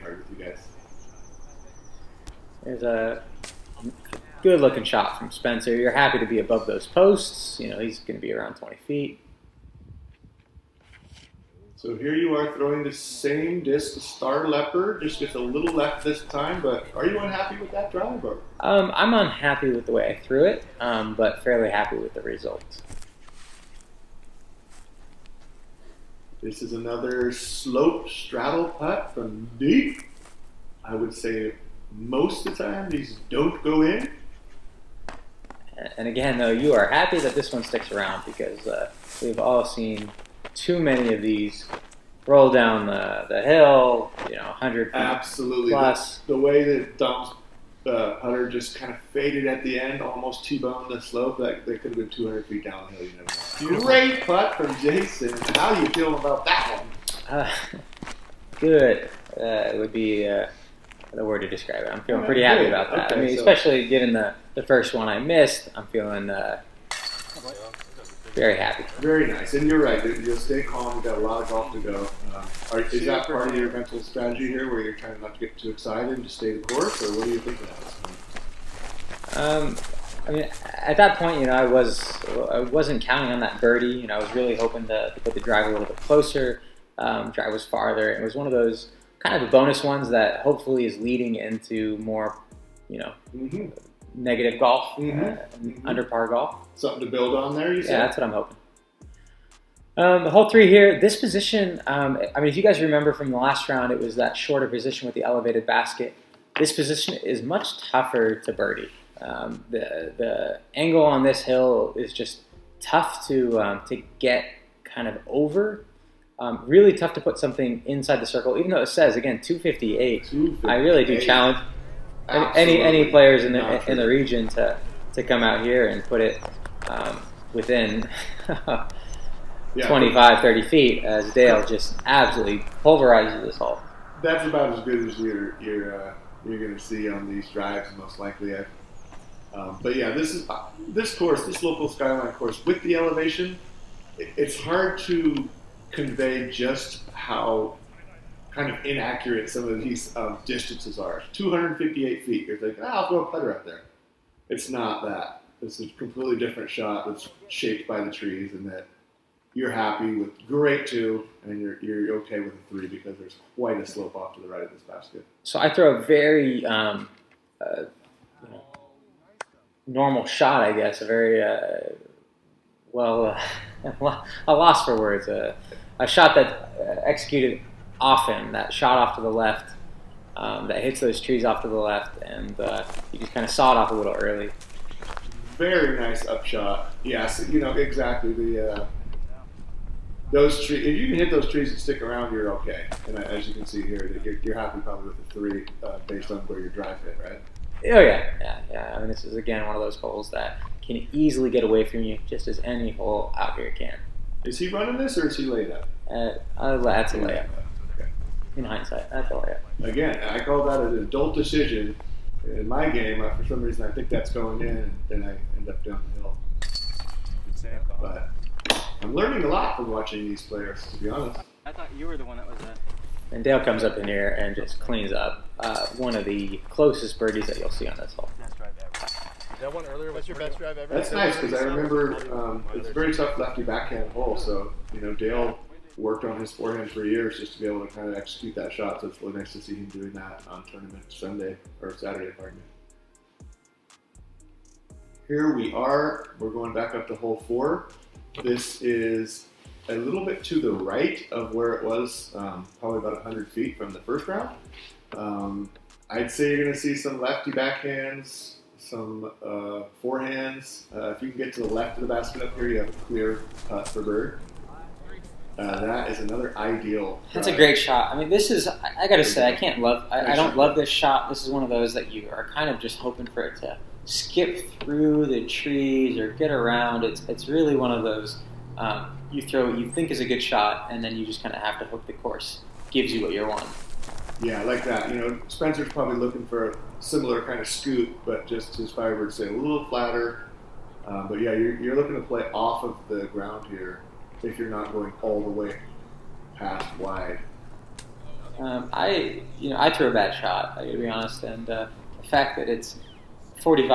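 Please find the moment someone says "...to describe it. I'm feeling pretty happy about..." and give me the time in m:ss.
1:01.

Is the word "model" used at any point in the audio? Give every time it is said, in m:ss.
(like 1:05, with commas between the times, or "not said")
not said.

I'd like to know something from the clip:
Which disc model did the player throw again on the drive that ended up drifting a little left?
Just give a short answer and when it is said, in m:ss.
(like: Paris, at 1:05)
Star Leopard, at 0:14.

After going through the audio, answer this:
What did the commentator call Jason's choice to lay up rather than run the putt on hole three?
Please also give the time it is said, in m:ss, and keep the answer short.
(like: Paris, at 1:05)
An adult decision, at 3:30.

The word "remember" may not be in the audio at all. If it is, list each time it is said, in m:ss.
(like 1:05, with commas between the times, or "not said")
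1:42, 3:51.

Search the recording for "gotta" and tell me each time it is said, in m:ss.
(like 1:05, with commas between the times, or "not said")
4:29, 5:00.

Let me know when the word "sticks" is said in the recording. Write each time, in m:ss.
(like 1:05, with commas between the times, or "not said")
0:37, 3:11.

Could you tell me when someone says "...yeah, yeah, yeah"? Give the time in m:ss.
3:17.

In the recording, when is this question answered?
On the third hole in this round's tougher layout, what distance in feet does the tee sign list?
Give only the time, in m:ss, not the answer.
1:59.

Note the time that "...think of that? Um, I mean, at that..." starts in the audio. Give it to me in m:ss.
1:17.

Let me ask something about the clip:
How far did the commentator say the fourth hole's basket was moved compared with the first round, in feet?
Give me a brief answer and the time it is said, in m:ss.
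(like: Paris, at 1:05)
About 100, at 4:12.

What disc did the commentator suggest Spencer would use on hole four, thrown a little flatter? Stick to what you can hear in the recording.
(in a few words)
Firebird.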